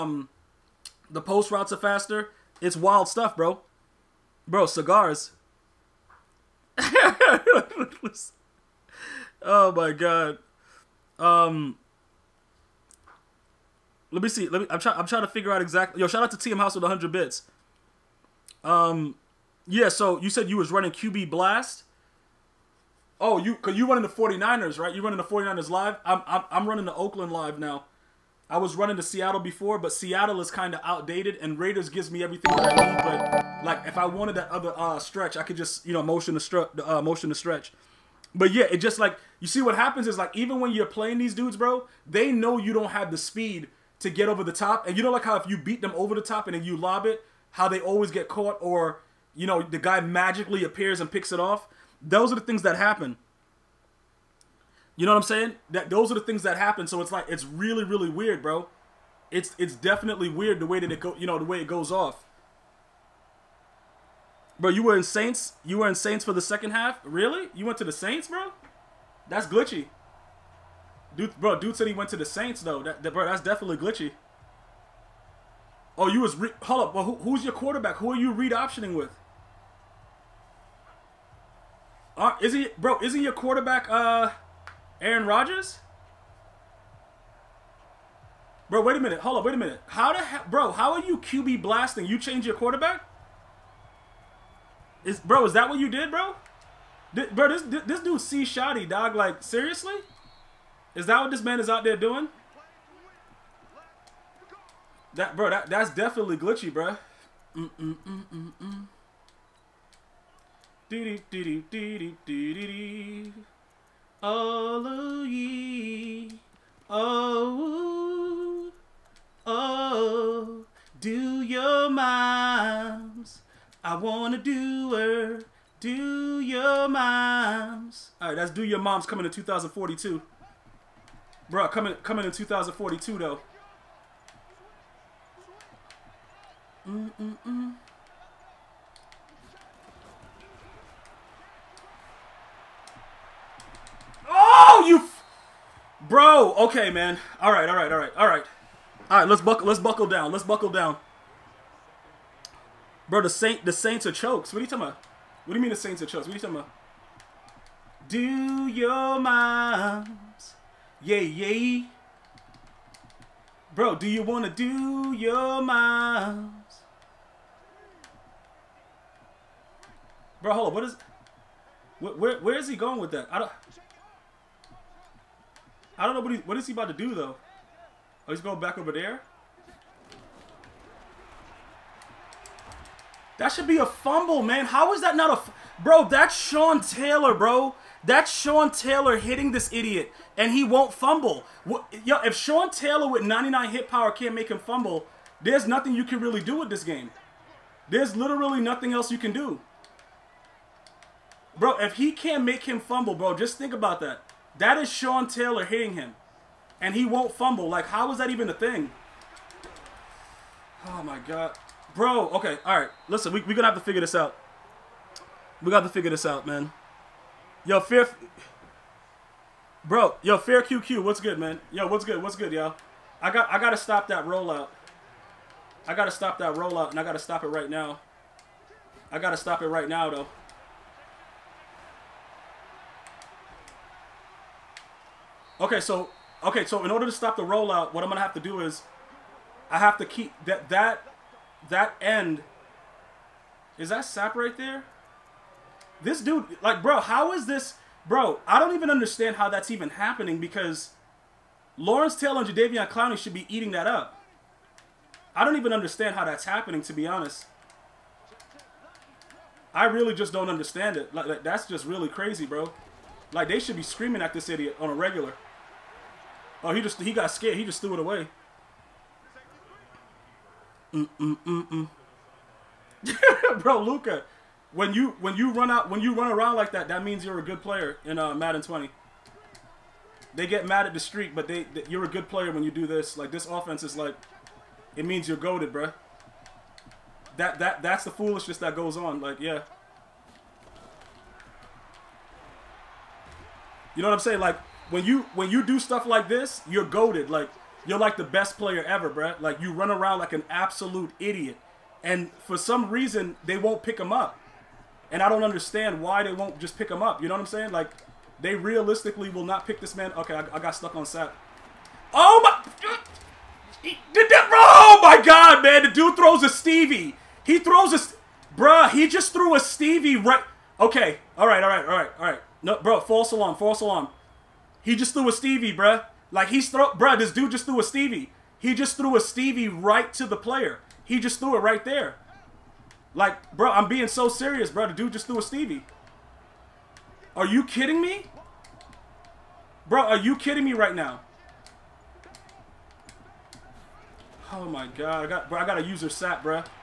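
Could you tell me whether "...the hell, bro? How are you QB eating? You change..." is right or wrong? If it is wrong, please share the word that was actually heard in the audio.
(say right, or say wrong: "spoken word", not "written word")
wrong: "blasting", not "eating".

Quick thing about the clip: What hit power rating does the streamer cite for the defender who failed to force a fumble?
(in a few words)
99.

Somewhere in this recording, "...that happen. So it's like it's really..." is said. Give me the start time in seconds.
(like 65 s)
56 s.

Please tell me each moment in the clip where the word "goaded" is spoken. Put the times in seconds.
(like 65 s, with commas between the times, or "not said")
285 s, 296 s.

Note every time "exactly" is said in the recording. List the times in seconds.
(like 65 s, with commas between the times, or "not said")
15 s.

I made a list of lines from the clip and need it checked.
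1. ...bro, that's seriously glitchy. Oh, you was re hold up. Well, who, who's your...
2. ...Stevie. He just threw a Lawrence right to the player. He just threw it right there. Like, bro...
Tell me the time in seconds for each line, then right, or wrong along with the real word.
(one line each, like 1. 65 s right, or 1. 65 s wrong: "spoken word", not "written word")
1. 73 s wrong: "definitely", not "seriously"
2. 327 s wrong: "Stevie", not "Lawrence".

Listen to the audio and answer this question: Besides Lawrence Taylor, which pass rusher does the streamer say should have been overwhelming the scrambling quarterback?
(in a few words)
Jadeveon Clowney.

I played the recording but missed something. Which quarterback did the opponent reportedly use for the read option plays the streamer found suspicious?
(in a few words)
Aaron Rodgers.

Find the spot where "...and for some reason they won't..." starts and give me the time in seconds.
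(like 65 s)
302 s.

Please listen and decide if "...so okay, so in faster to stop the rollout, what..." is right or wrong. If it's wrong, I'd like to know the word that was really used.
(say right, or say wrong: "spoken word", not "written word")
wrong: "order", not "faster".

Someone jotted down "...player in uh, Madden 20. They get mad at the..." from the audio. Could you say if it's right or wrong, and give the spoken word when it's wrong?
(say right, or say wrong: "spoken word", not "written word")
right.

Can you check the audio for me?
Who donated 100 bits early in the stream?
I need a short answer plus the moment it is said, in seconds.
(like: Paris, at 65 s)
TM House, at 16 s.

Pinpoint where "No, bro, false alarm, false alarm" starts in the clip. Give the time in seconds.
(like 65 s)
322 s.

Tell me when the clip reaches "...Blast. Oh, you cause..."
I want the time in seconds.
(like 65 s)
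21 s.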